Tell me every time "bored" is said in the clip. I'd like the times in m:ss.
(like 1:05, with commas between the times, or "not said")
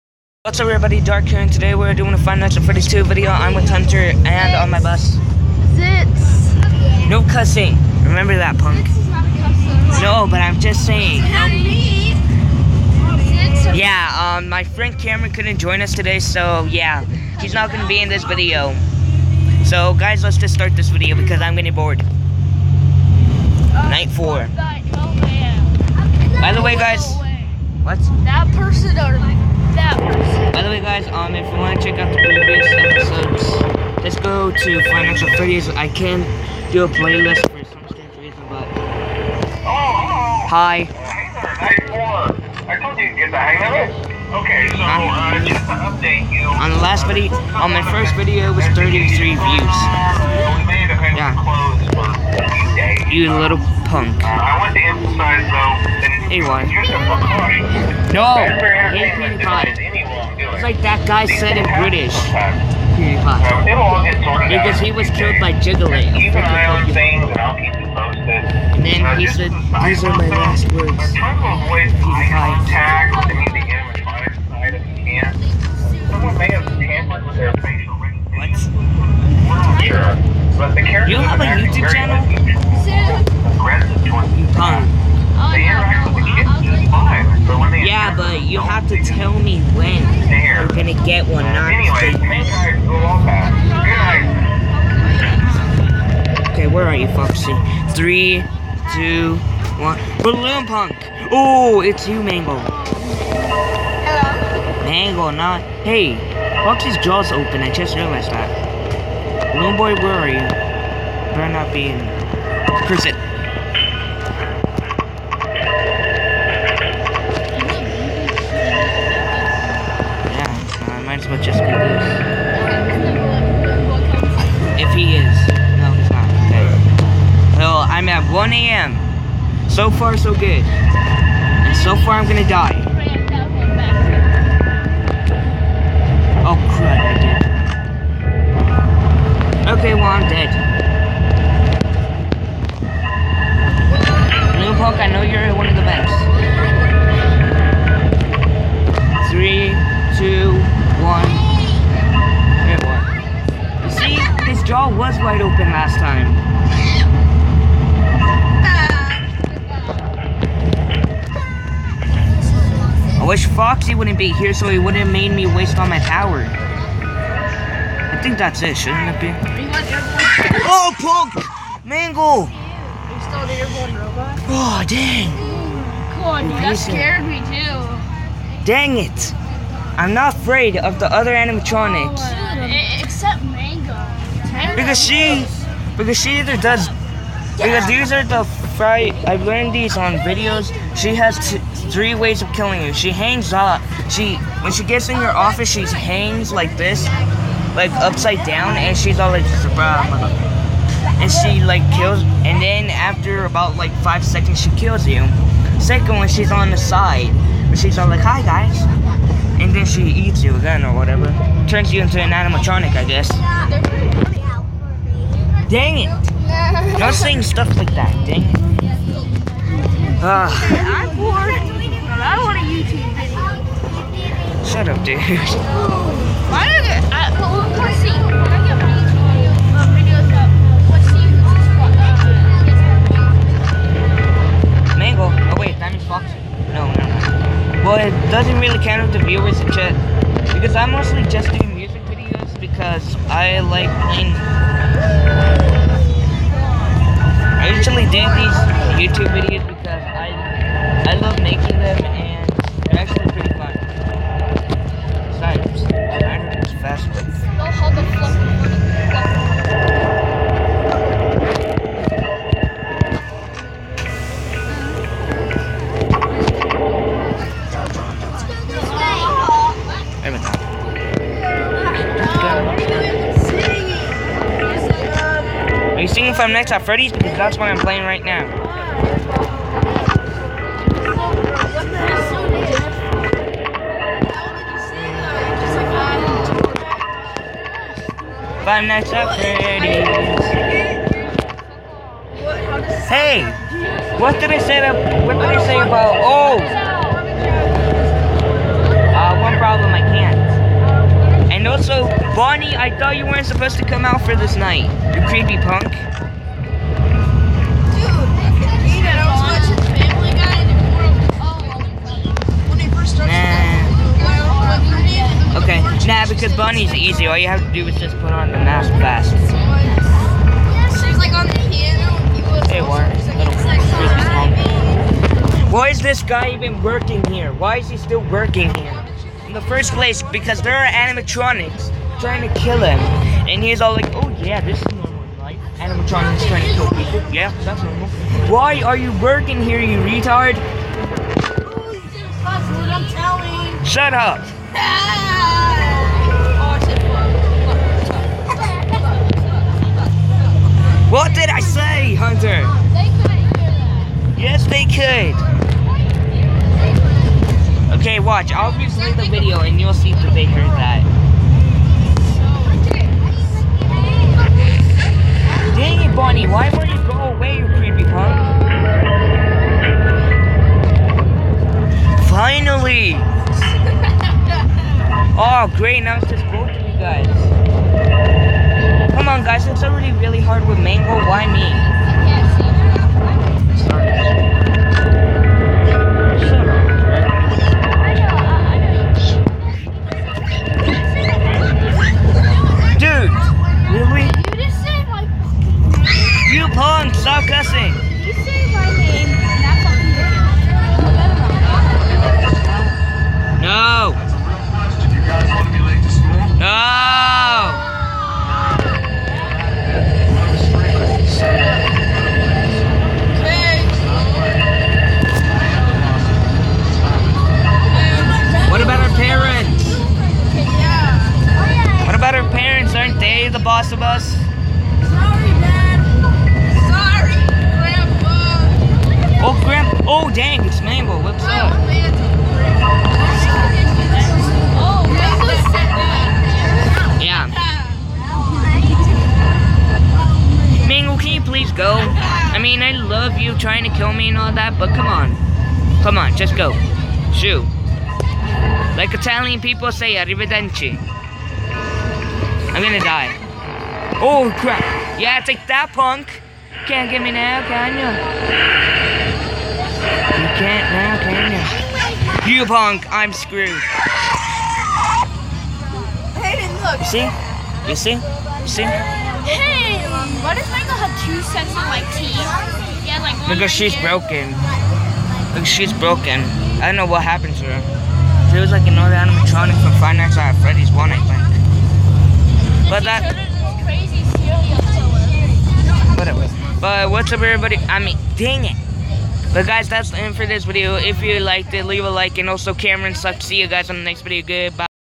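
0:21, 3:41.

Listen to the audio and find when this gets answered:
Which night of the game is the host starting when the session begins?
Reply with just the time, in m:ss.
0:23.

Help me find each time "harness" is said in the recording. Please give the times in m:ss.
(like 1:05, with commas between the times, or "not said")
not said.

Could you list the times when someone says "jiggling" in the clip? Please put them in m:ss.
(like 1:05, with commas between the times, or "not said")
1:05.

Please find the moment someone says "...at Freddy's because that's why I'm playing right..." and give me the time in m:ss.
4:36.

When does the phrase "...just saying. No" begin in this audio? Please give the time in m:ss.
0:10.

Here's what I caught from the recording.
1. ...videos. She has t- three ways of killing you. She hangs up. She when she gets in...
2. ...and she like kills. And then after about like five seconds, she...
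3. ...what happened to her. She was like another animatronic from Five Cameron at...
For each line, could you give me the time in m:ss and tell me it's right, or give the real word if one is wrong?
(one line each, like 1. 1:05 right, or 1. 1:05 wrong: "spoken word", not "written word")
1. 3:10 right
2. 3:21 right
3. 7:57 wrong: "Nights", not "Cameron".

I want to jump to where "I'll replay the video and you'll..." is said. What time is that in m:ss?
5:58.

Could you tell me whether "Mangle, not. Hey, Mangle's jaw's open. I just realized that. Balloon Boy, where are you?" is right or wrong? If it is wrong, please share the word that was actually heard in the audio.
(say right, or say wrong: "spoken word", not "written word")
wrong: "Foxy", not "Mangle".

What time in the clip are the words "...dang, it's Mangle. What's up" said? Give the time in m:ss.
7:10.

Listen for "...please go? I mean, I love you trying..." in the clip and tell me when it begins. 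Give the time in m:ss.
7:21.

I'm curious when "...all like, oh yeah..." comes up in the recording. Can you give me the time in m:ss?
5:33.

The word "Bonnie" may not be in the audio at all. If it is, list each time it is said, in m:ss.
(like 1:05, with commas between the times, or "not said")
5:02, 5:16, 6:06.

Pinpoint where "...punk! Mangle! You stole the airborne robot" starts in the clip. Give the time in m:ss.
2:50.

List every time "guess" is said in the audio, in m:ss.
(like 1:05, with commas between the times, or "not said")
3:33.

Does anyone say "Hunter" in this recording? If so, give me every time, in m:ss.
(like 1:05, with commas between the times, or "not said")
0:03, 5:52.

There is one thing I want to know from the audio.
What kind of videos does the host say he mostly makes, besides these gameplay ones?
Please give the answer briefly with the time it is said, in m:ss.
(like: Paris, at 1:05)
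music videos, at 4:01.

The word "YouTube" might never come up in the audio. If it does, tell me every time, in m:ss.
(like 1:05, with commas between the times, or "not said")
3:42, 4:08.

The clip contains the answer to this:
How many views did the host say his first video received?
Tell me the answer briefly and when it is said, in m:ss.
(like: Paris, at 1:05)
33, at 0:48.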